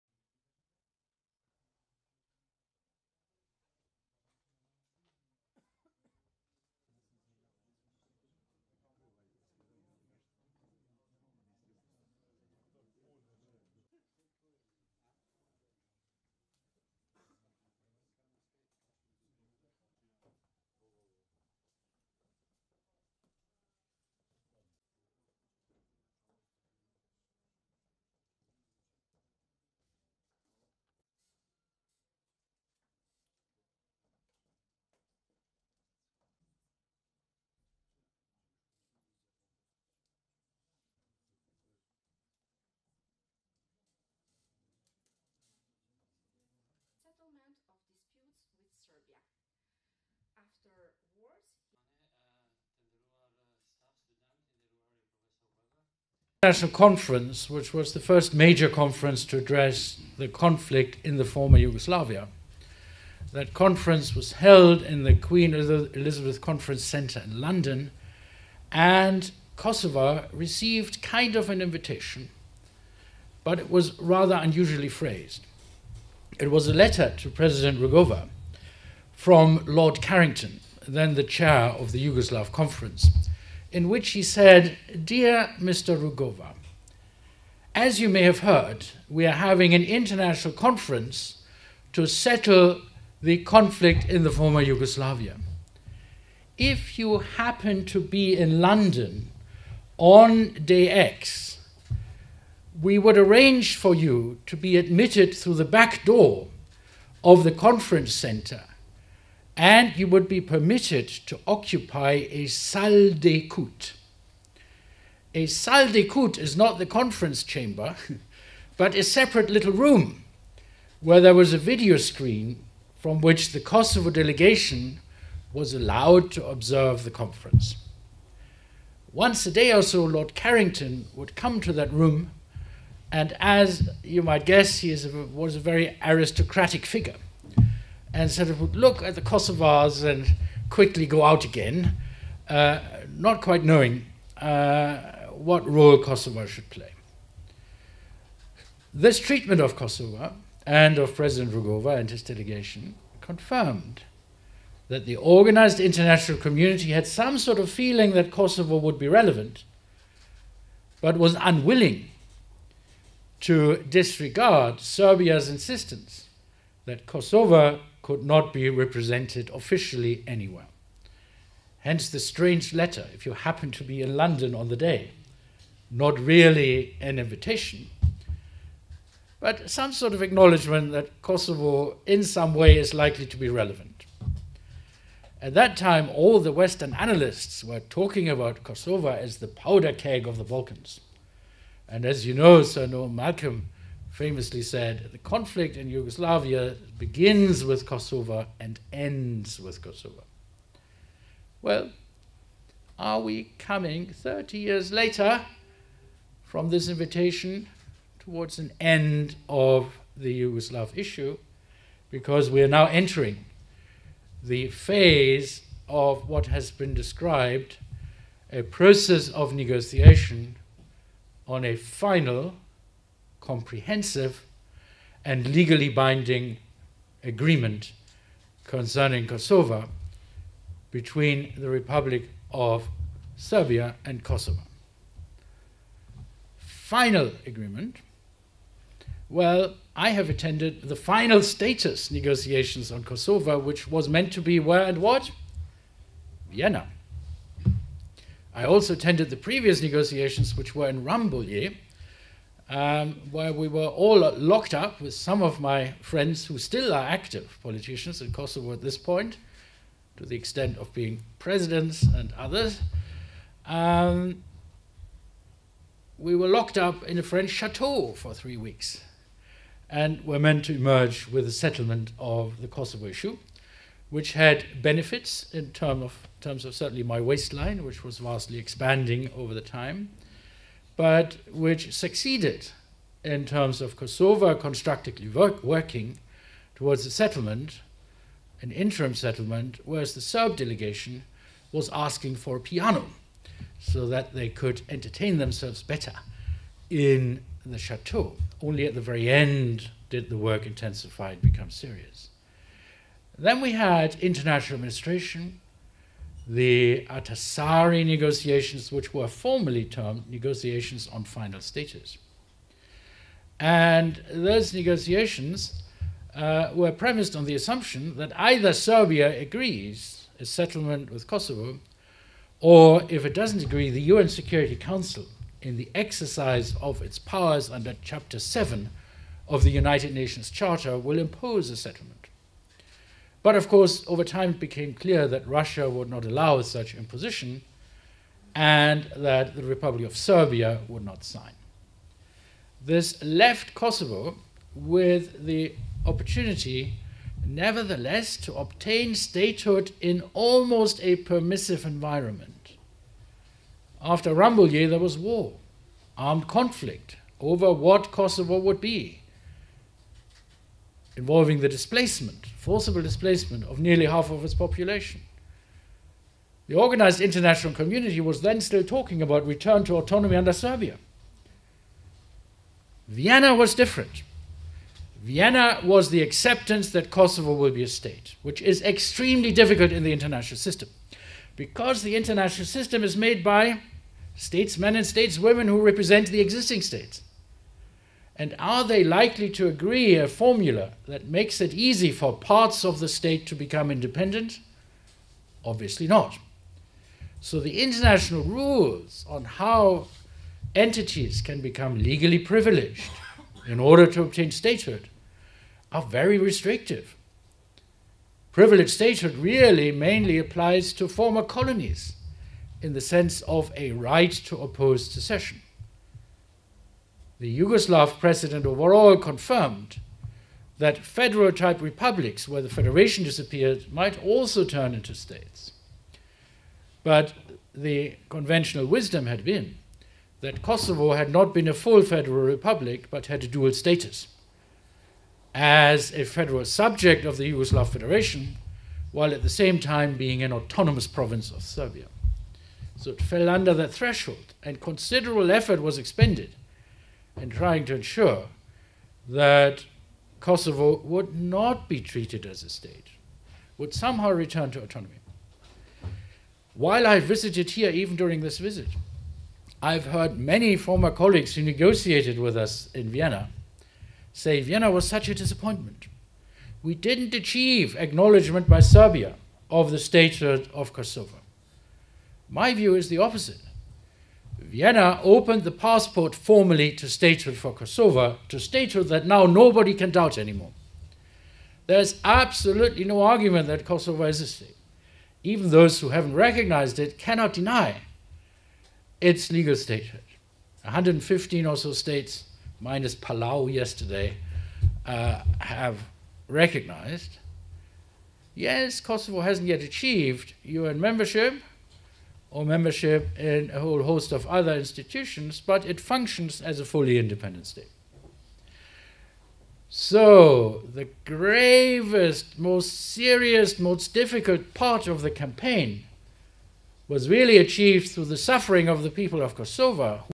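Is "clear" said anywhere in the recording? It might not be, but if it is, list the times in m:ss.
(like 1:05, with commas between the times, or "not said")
5:34.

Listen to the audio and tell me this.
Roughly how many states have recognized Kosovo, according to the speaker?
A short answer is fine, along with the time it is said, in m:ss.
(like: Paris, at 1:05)
115, at 8:10.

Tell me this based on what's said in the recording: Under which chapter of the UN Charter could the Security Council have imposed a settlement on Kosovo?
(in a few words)
Chapter 7.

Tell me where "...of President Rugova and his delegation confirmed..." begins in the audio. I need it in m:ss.
2:30.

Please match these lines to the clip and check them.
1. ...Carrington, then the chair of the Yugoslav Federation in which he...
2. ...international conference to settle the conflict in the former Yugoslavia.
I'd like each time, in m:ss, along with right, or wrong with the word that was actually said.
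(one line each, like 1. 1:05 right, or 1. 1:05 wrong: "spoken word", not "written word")
1. 1:20 wrong: "Conference", not "Federation"
2. 1:29 right.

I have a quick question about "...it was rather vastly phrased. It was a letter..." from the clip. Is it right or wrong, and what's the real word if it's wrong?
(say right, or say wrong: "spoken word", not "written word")
wrong: "unusually", not "vastly".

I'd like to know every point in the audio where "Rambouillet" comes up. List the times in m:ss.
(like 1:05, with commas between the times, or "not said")
4:11, 5:54.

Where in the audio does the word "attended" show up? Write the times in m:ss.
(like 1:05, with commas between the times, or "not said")
4:00, 4:08.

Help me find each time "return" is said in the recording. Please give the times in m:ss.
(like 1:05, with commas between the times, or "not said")
6:09, 7:34.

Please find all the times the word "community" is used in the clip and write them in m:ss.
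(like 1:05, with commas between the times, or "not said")
2:36, 6:07.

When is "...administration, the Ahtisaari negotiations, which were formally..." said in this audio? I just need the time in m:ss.
5:04.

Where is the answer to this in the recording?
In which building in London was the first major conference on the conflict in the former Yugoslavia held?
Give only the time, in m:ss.
1:05.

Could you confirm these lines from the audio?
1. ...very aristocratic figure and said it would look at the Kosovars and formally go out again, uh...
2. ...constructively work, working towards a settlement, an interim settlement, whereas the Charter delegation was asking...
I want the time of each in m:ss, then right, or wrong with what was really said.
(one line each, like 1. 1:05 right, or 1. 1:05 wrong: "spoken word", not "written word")
1. 2:15 wrong: "quickly", not "formally"
2. 4:44 wrong: "Serb", not "Charter".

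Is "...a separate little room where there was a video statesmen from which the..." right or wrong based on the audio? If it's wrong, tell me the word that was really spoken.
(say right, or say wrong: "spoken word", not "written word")
wrong: "screen", not "statesmen".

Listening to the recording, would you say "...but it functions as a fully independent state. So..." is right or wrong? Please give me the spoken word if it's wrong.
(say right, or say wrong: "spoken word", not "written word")
right.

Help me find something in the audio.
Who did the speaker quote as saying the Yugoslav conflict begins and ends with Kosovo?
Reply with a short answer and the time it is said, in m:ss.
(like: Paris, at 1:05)
Sir Noel Malcolm, at 3:12.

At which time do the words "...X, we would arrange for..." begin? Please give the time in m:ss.
1:40.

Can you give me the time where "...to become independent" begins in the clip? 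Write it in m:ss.
6:33.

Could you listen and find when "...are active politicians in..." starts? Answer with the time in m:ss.
4:16.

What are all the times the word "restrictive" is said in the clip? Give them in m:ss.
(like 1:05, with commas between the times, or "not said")
6:46.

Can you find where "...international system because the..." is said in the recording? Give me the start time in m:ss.
6:20.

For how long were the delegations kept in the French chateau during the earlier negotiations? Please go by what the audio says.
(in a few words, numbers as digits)
three weeks.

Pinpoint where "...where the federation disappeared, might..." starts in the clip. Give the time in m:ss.
7:02.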